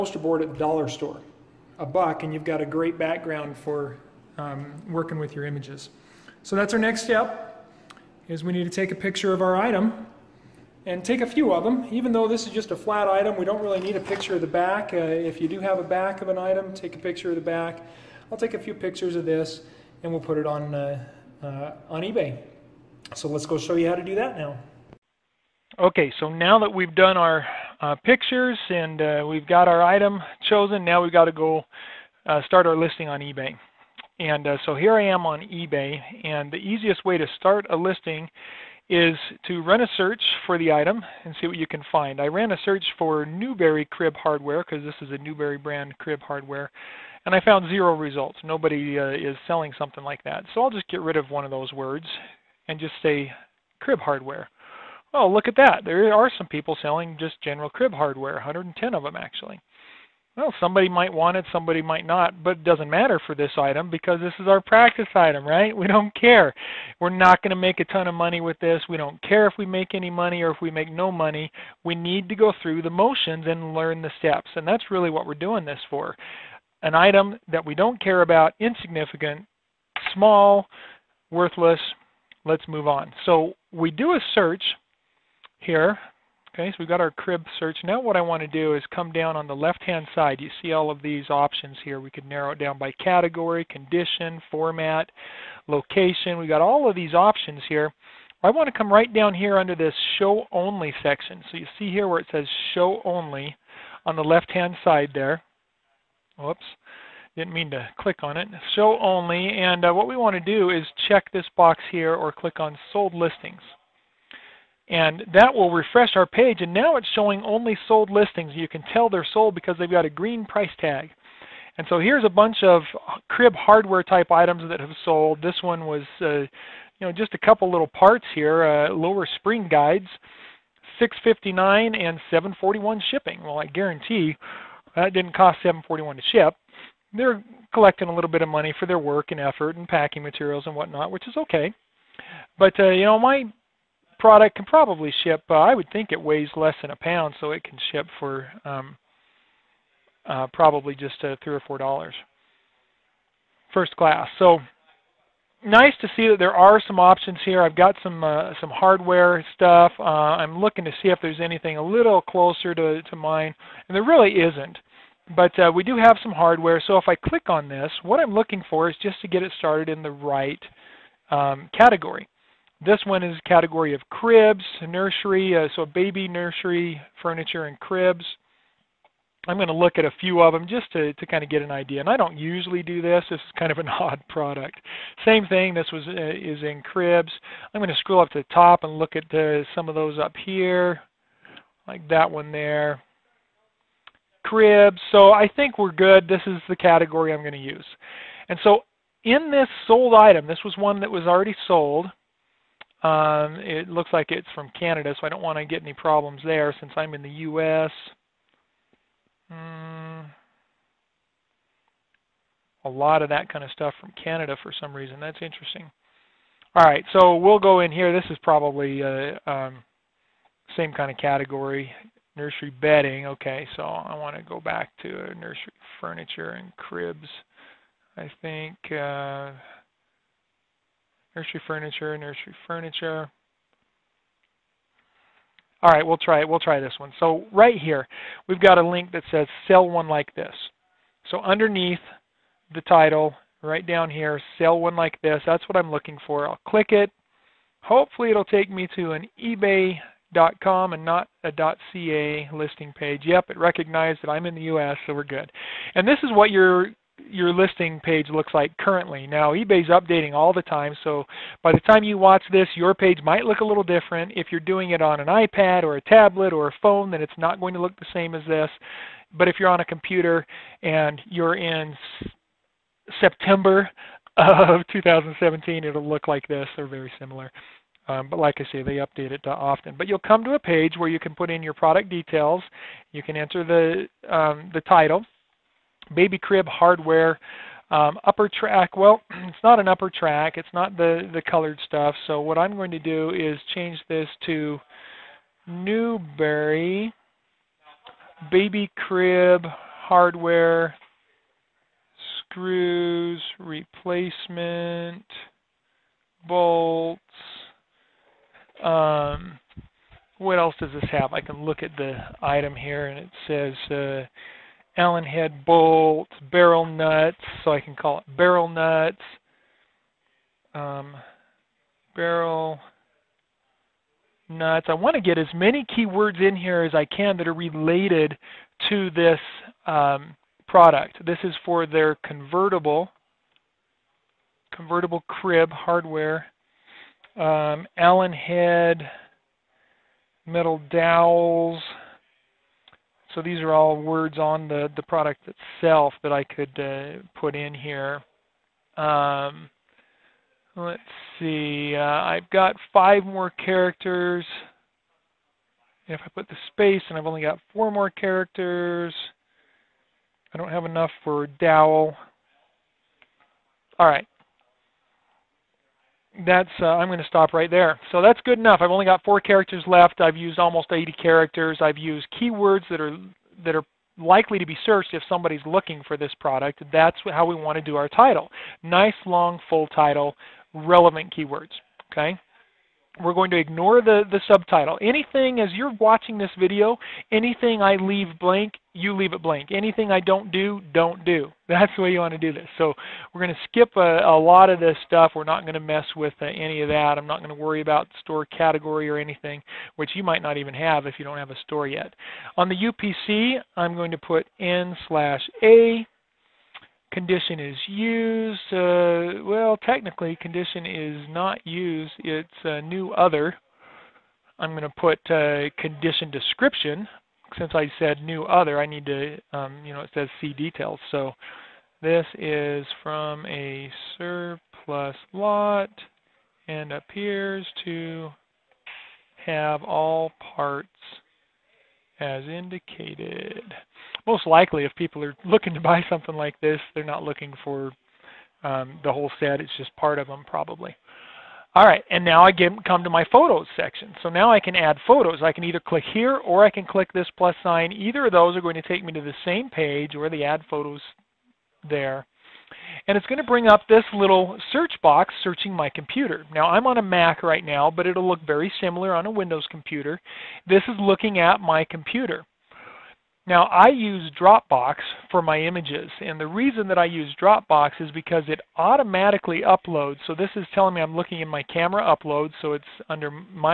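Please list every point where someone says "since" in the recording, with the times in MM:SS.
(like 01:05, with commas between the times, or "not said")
03:26, 06:57.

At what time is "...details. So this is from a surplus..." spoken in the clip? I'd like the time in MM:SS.
07:00.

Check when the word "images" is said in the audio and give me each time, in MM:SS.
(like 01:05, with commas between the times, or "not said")
00:05, 07:45.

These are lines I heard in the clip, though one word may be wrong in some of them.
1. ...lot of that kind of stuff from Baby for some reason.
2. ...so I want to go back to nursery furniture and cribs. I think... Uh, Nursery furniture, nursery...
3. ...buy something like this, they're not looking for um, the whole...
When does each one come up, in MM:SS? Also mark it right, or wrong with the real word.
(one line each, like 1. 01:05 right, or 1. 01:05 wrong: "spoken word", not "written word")
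1. 03:32 wrong: "Canada", not "Baby"
2. 03:43 right
3. 07:15 right.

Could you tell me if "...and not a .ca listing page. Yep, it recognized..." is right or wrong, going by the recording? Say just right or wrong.
right.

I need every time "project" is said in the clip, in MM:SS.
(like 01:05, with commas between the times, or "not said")
not said.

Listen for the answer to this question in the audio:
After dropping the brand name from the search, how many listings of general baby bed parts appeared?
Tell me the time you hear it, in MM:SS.
00:58.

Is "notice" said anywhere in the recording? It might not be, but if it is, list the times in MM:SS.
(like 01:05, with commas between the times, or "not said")
not said.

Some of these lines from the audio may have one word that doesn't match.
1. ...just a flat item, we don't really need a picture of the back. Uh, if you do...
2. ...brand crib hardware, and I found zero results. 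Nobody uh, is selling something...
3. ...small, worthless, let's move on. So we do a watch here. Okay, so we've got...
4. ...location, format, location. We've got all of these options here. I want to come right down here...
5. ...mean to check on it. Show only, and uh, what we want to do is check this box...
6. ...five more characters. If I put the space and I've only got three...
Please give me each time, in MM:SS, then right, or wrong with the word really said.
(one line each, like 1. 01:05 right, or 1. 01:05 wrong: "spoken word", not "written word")
1. 00:12 right
2. 00:45 right
3. 01:20 wrong: "search", not "watch"
4. 01:33 wrong: "condition", not "location"
5. 01:47 wrong: "click", not "check"
6. 05:52 wrong: "four", not "three".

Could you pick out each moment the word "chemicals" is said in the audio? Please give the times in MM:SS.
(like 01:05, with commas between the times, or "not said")
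not said.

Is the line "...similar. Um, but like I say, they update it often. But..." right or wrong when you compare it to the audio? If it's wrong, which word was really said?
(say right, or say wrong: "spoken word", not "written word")
right.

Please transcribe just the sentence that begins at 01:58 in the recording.
You can tell they're sold because they've got a green price tag.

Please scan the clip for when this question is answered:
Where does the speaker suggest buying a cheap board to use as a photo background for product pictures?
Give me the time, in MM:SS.
00:00.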